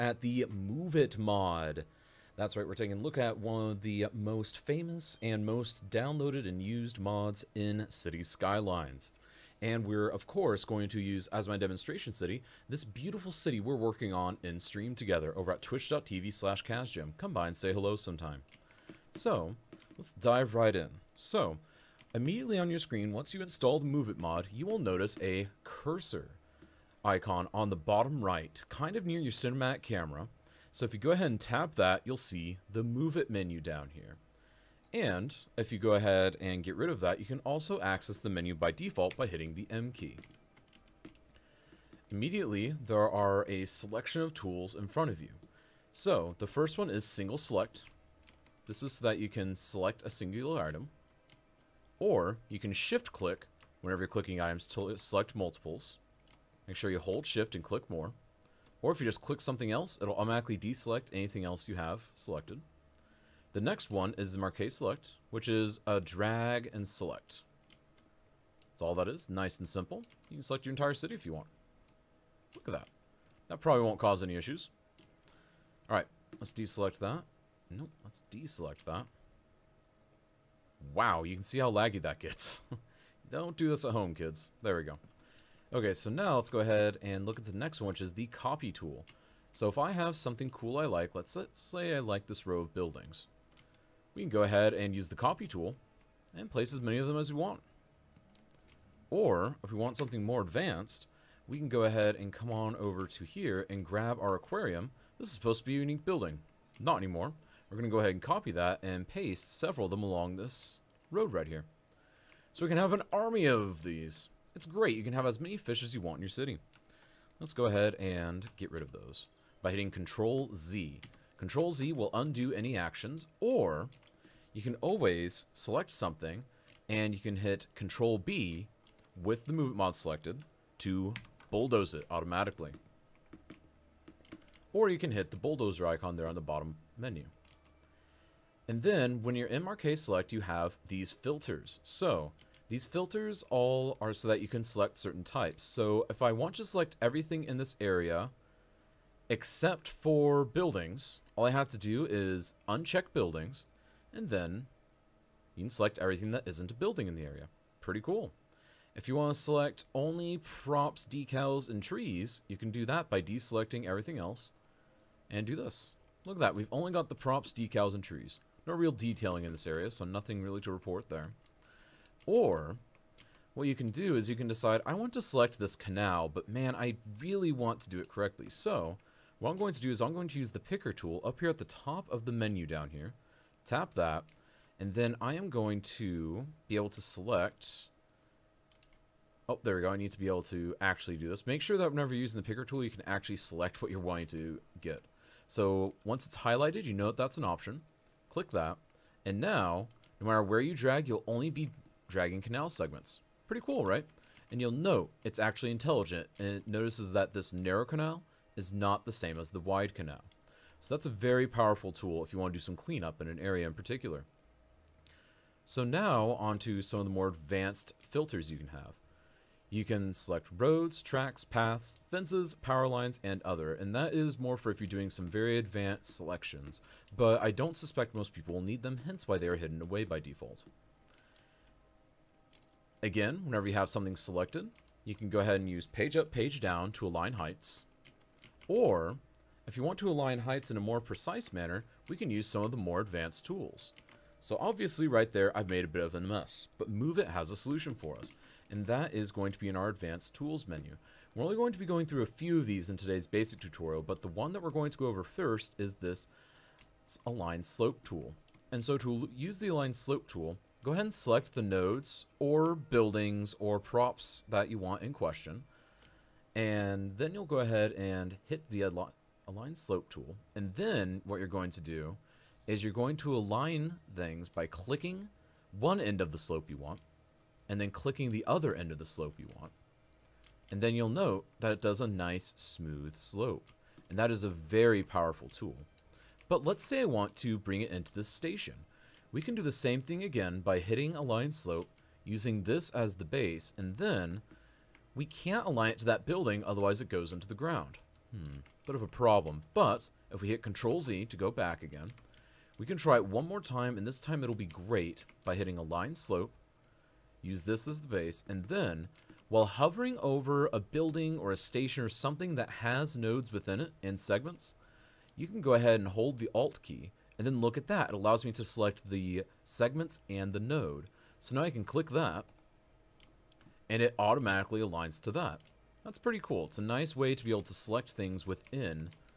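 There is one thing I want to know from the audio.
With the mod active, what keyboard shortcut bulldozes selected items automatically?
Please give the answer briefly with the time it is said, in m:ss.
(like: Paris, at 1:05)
Control B, at 2:07.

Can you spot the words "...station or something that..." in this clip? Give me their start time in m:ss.
5:11.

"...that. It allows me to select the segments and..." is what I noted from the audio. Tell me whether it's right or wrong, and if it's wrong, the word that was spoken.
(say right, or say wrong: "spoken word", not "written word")
right.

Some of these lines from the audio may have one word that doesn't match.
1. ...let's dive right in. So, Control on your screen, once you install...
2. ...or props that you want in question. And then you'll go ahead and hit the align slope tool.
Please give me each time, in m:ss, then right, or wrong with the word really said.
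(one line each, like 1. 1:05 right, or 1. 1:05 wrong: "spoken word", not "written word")
1. 0:19 wrong: "Immediately", not "Control"
2. 4:23 right.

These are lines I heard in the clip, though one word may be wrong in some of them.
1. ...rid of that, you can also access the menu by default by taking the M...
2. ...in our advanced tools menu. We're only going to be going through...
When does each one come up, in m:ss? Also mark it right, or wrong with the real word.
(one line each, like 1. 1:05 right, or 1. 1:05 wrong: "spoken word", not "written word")
1. 0:36 wrong: "hitting", not "taking"
2. 4:09 right.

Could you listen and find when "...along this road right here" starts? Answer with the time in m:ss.
1:50.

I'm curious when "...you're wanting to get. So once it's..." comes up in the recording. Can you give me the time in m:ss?
3:13.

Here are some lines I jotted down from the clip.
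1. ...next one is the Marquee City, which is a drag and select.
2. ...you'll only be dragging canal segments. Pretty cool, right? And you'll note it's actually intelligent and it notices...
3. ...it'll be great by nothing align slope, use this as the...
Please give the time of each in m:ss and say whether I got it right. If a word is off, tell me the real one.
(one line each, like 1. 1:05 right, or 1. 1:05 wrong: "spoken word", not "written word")
1. 1:03 wrong: "Select", not "City"
2. 3:21 right
3. 5:04 wrong: "hitting", not "nothing".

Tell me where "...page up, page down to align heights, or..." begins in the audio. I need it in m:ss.
3:55.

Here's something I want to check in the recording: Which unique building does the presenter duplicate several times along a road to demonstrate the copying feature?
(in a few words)
Aquarium.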